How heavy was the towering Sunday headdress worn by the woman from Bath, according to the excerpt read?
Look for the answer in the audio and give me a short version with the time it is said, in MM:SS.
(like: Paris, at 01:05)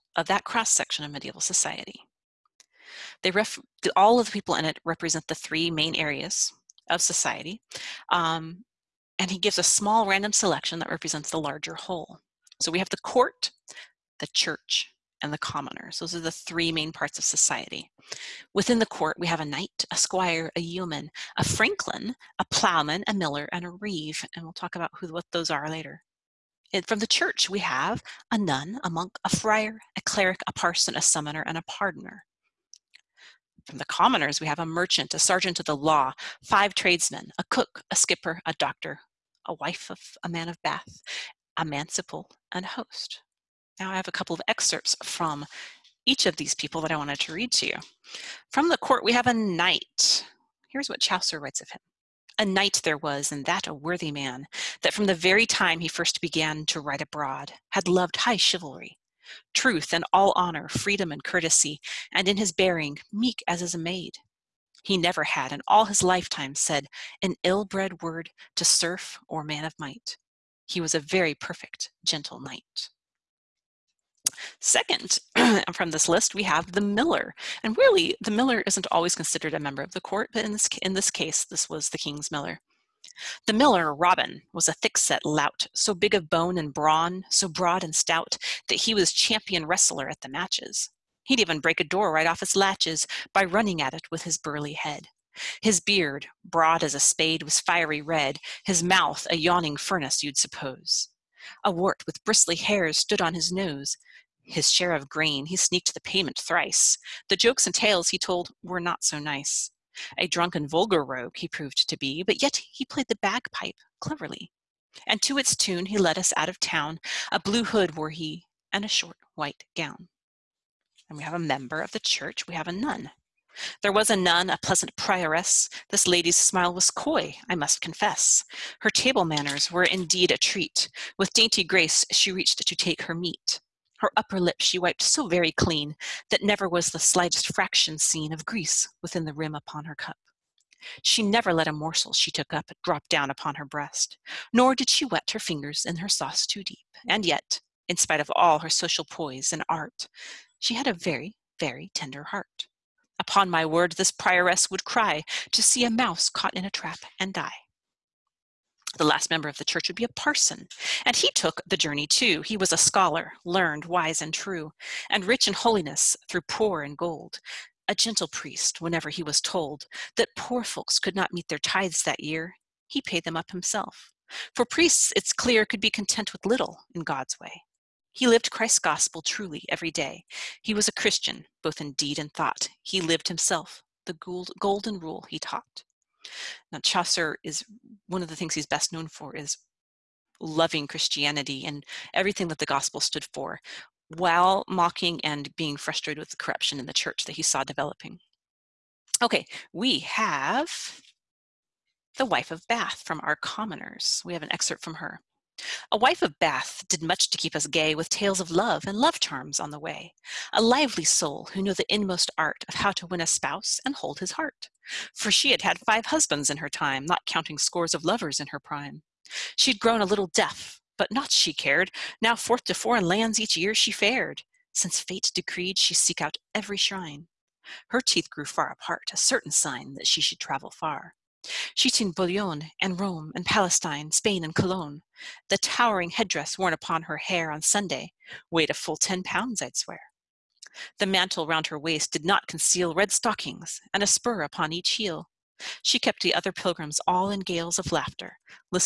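10 pounds, at 03:58.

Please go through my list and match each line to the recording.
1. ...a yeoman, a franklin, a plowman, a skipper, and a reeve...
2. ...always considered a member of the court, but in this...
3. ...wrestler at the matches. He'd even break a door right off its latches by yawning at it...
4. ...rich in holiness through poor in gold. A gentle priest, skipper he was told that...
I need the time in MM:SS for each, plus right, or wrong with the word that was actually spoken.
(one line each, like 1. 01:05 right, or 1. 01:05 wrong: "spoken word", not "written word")
1. 00:20 wrong: "miller", not "skipper"
2. 01:18 right
3. 01:29 wrong: "running", not "yawning"
4. 02:45 wrong: "whenever", not "skipper".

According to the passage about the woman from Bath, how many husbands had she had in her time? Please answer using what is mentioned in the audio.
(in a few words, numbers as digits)
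5.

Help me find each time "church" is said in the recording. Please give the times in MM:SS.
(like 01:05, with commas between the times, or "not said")
00:14, 00:27, 02:01, 02:39, 03:16.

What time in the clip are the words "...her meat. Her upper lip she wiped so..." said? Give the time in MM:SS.
02:13.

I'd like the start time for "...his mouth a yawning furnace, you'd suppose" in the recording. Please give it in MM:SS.
01:38.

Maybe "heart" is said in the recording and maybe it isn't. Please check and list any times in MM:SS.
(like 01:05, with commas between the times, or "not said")
02:32, 03:34.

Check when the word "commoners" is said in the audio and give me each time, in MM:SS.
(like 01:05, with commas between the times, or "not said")
00:15, 00:33, 03:23.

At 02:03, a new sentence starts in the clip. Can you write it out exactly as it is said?
There was a nun, a pleasant prioress.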